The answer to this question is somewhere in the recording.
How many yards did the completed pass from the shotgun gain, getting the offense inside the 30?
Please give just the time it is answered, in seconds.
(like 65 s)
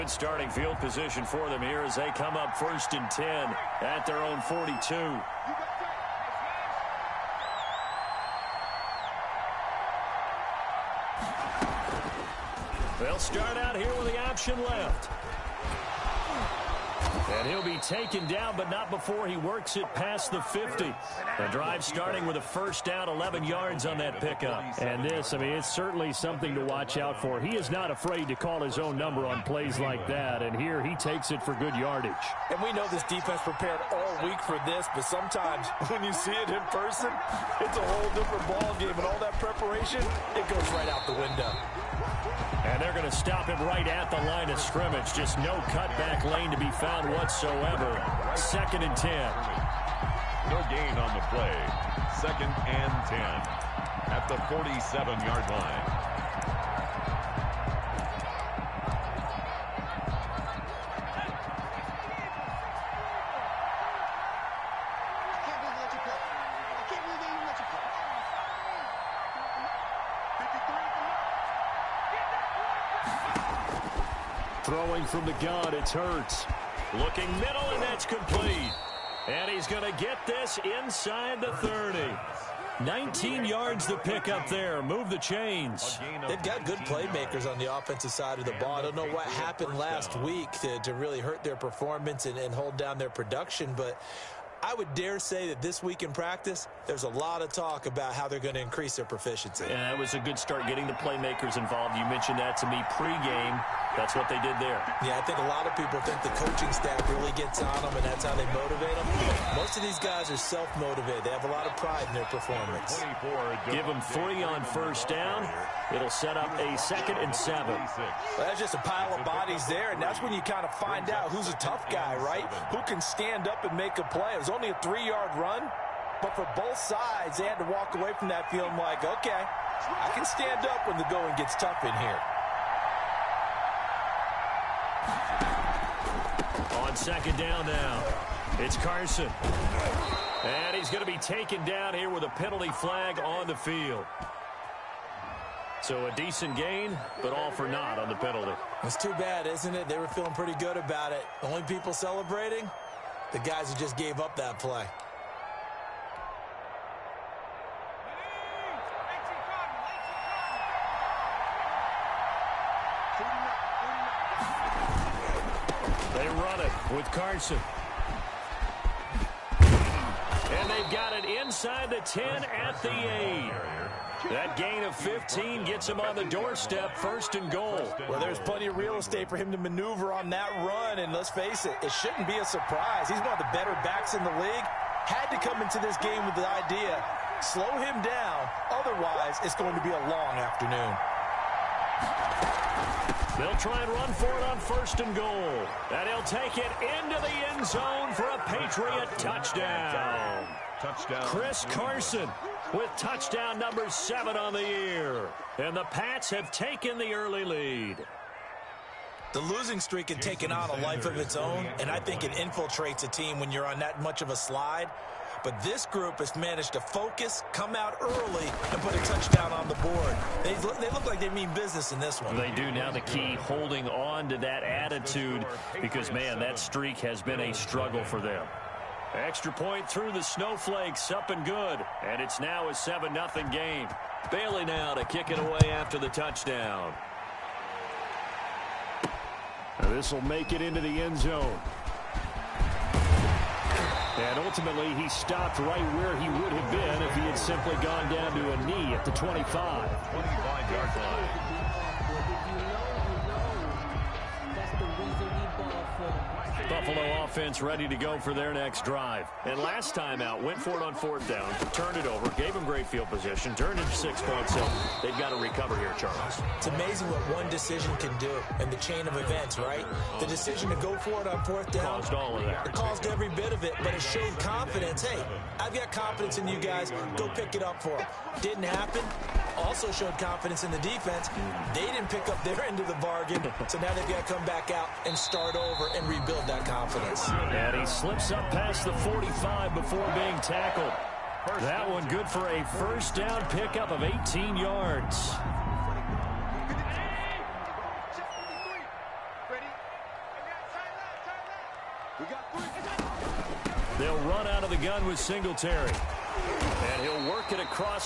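82 s.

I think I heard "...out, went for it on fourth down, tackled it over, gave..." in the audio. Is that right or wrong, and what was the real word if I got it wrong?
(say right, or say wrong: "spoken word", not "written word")
wrong: "turned", not "tackled".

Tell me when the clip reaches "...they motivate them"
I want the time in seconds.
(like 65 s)
108 s.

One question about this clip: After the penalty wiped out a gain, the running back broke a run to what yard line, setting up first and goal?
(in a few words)
8.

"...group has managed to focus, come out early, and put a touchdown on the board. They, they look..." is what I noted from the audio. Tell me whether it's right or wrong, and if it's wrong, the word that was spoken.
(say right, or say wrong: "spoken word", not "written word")
right.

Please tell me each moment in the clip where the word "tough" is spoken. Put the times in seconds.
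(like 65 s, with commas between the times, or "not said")
121 s, 131 s.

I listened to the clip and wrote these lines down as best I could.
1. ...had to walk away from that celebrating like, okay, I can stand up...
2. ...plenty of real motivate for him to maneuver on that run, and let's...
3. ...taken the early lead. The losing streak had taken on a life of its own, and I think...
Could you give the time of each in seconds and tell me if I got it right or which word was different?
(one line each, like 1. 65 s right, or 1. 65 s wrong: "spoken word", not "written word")
1. 127 s wrong: "feeling", not "celebrating"
2. 178 s wrong: "estate", not "motivate"
3. 206 s right.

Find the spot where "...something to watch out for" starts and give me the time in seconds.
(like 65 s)
26 s.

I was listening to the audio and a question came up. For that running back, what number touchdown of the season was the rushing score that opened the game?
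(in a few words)
7.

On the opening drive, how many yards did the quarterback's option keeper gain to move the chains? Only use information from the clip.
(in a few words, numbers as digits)
11.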